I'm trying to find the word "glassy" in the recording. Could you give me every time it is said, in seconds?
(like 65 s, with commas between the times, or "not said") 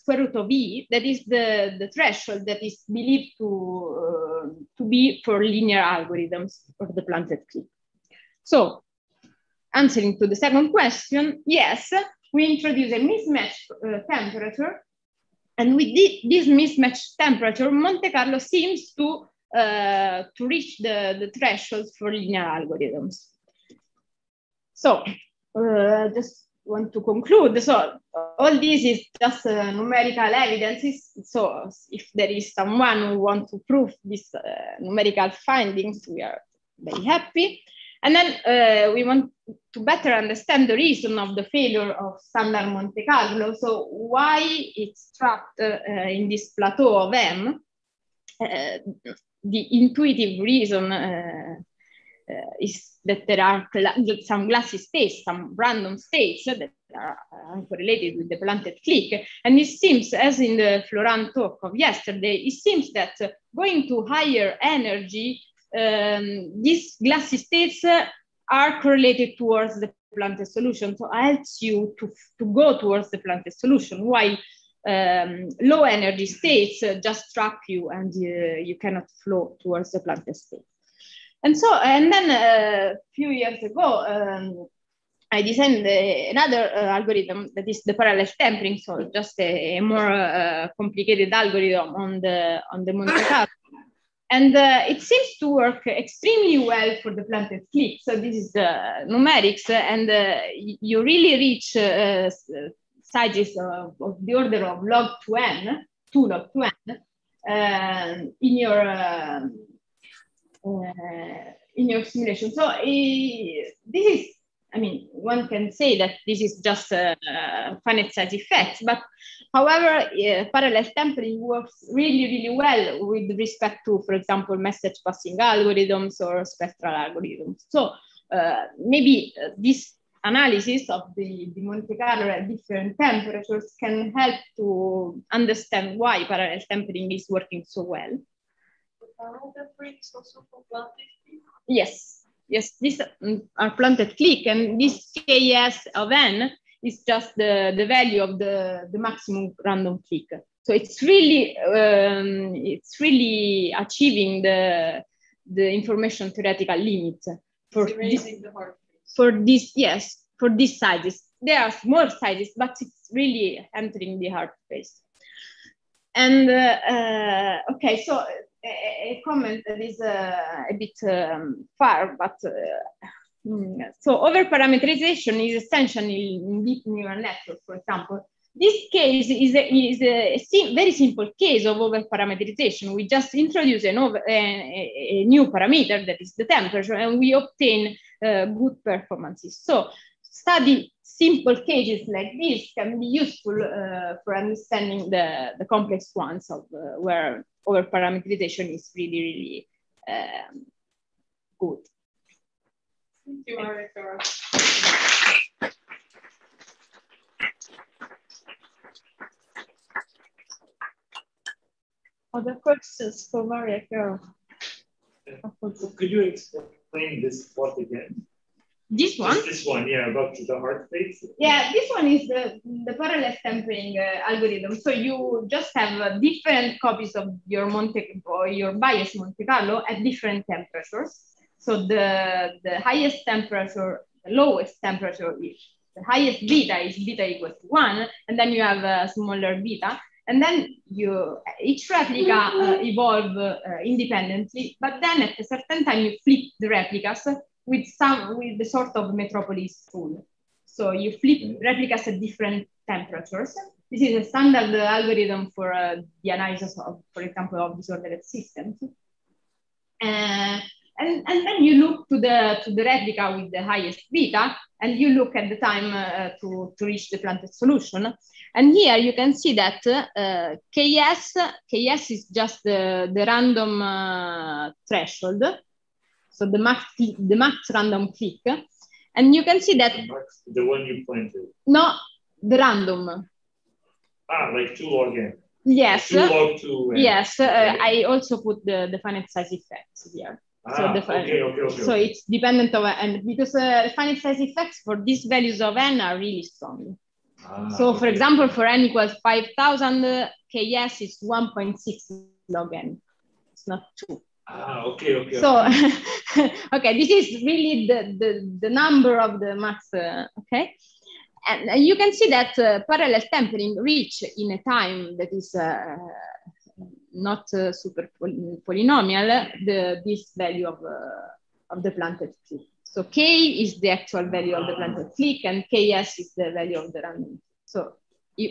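54 s, 67 s.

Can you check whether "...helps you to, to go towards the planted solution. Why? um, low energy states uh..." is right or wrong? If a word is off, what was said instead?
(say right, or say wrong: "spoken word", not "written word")
right.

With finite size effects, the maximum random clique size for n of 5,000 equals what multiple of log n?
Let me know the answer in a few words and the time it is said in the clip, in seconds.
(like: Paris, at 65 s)
1.6, at 301 s.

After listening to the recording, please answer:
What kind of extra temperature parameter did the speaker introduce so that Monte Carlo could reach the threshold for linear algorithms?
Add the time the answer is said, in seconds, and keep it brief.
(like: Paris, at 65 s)
mismatch temperature, at 12 s.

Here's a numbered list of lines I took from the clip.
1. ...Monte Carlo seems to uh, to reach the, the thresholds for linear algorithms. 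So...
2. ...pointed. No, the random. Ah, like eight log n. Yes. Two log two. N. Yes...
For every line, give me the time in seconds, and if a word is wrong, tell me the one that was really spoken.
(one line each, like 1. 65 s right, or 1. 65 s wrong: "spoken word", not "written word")
1. 17 s right
2. 281 s wrong: "two", not "eight".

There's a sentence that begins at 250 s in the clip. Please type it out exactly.
So you flip replicas at different temperatures.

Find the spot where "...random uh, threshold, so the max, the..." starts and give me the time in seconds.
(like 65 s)
273 s.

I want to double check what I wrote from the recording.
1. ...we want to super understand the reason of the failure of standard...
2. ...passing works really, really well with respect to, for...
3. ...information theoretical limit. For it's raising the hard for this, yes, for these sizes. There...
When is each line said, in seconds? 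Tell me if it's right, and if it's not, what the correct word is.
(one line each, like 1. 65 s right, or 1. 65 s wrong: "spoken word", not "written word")
1. 38 s wrong: "better", not "super"
2. 120 s wrong: "sampling", not "passing"
3. 155 s right.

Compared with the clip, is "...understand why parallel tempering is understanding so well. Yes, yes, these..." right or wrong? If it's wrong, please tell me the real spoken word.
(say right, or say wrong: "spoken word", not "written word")
wrong: "working", not "understanding".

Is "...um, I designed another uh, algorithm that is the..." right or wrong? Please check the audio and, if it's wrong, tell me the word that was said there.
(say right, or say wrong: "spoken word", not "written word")
right.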